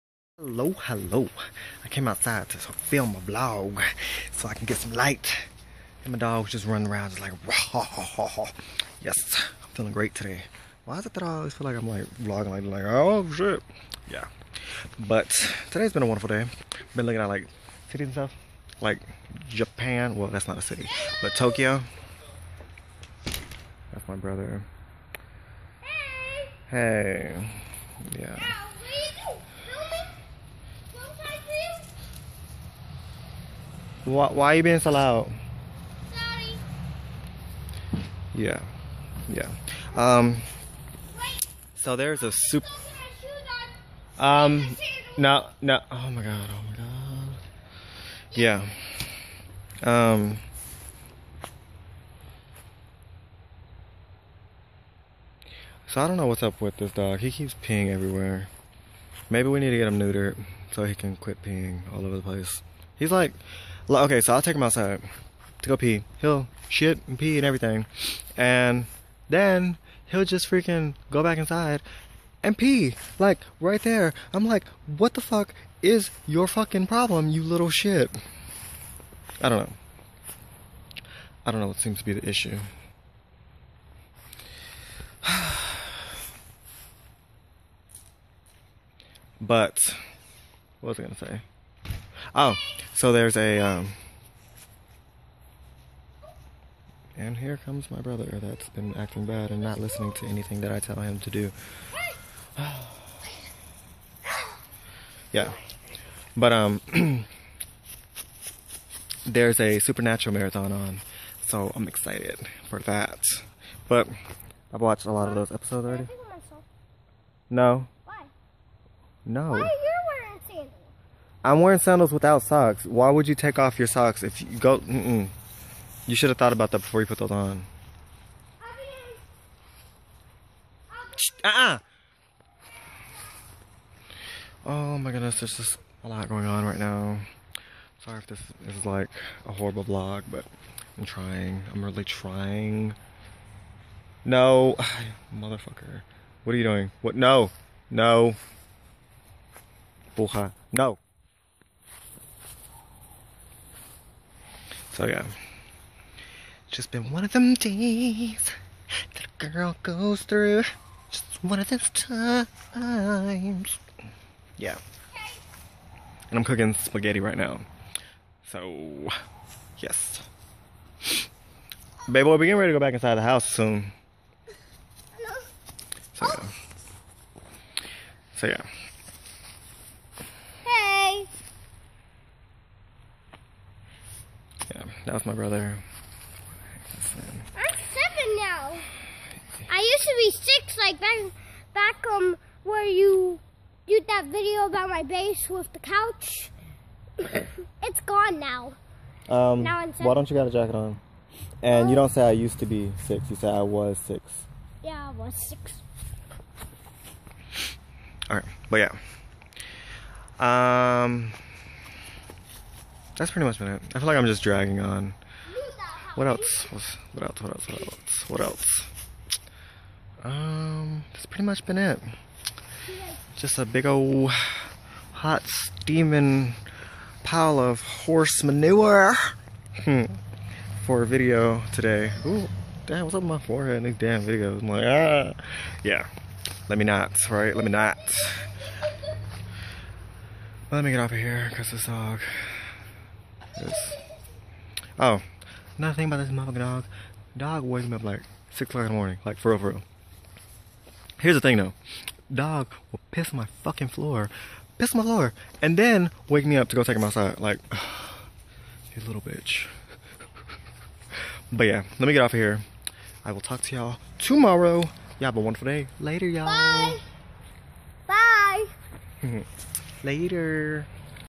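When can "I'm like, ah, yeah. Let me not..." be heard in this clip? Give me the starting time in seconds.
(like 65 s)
234 s.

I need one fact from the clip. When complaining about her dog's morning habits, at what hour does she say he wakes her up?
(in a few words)
6 o'clock.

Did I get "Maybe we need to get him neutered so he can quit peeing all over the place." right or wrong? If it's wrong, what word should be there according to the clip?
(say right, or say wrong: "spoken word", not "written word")
right.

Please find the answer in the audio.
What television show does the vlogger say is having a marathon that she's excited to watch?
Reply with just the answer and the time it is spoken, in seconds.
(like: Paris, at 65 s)
Supernatural, at 109 s.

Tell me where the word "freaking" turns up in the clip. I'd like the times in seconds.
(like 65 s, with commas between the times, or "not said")
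70 s.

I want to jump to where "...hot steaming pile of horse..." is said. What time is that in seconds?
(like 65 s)
225 s.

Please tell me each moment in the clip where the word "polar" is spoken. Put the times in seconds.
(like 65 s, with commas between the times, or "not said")
not said.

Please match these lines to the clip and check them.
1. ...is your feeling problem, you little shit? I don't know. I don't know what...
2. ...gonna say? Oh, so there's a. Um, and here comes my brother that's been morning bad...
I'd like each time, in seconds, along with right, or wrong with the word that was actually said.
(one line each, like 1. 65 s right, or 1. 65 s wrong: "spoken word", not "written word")
1. 75 s wrong: "fucking", not "feeling"
2. 91 s wrong: "acting", not "morning".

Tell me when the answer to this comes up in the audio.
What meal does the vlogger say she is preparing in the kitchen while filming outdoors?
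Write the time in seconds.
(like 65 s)
166 s.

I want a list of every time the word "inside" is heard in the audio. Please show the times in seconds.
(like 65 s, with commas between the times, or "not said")
71 s, 172 s.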